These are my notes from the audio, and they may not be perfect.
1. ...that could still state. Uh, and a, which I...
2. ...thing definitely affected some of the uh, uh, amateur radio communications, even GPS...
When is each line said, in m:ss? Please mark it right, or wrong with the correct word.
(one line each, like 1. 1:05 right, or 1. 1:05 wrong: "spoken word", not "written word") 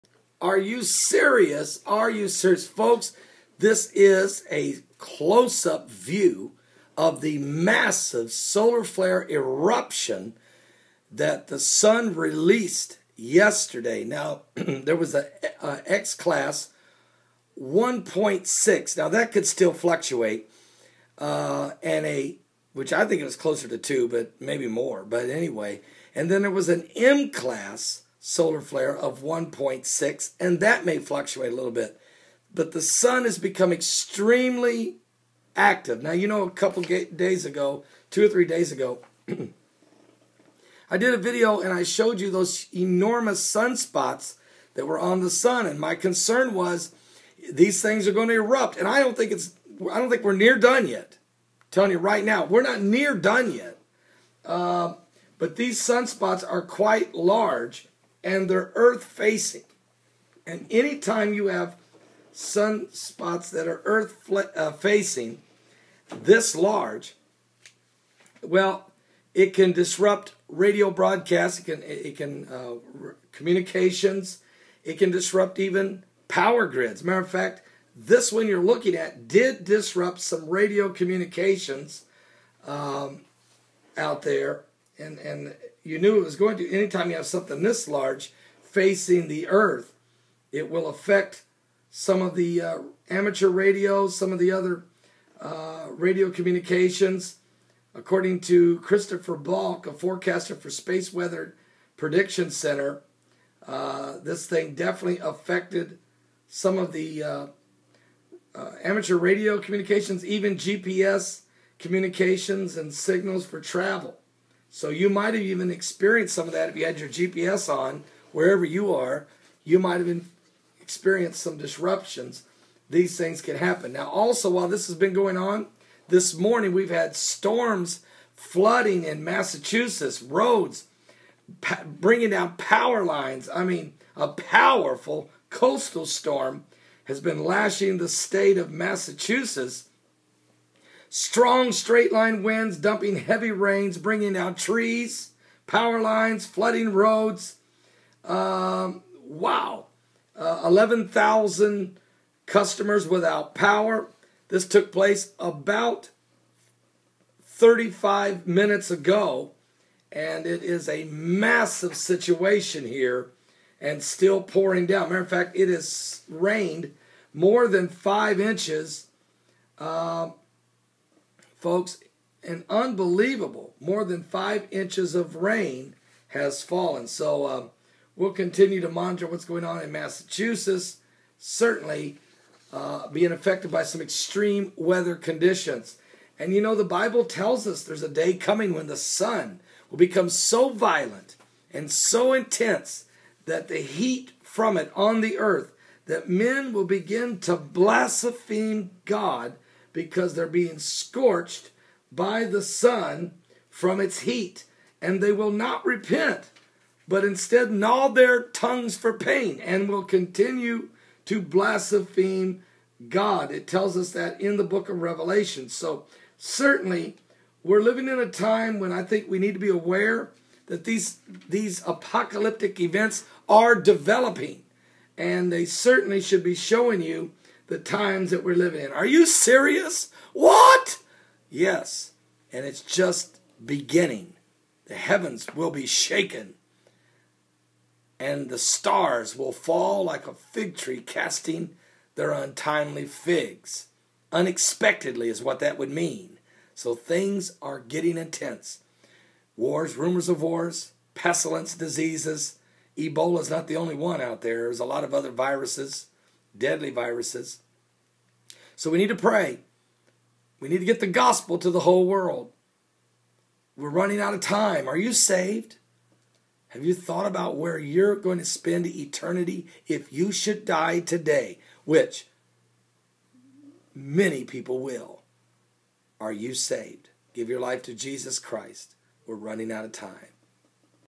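1. 0:19 wrong: "fluctuate", not "state"
2. 1:44 right.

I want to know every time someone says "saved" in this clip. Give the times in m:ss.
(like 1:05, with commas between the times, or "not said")
4:25, 4:36.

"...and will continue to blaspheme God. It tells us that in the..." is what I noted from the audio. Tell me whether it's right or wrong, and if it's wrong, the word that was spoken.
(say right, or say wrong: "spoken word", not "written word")
right.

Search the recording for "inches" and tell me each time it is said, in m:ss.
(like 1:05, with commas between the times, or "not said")
2:48, 2:54.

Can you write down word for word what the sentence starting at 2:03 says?
Now, also, while this has been going on, this morning we've had storms flooding in Massachusetts, roads bringing down power lines.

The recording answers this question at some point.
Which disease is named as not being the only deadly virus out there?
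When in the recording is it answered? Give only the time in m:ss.
4:12.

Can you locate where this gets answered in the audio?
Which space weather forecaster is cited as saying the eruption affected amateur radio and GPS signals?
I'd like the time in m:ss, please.
1:38.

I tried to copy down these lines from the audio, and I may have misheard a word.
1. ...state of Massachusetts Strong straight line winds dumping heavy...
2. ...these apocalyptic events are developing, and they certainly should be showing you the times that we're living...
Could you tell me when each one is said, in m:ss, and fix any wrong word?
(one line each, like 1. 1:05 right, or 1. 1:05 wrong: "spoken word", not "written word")
1. 2:18 right
2. 3:41 right.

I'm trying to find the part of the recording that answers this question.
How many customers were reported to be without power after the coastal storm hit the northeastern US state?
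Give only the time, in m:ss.
2:30.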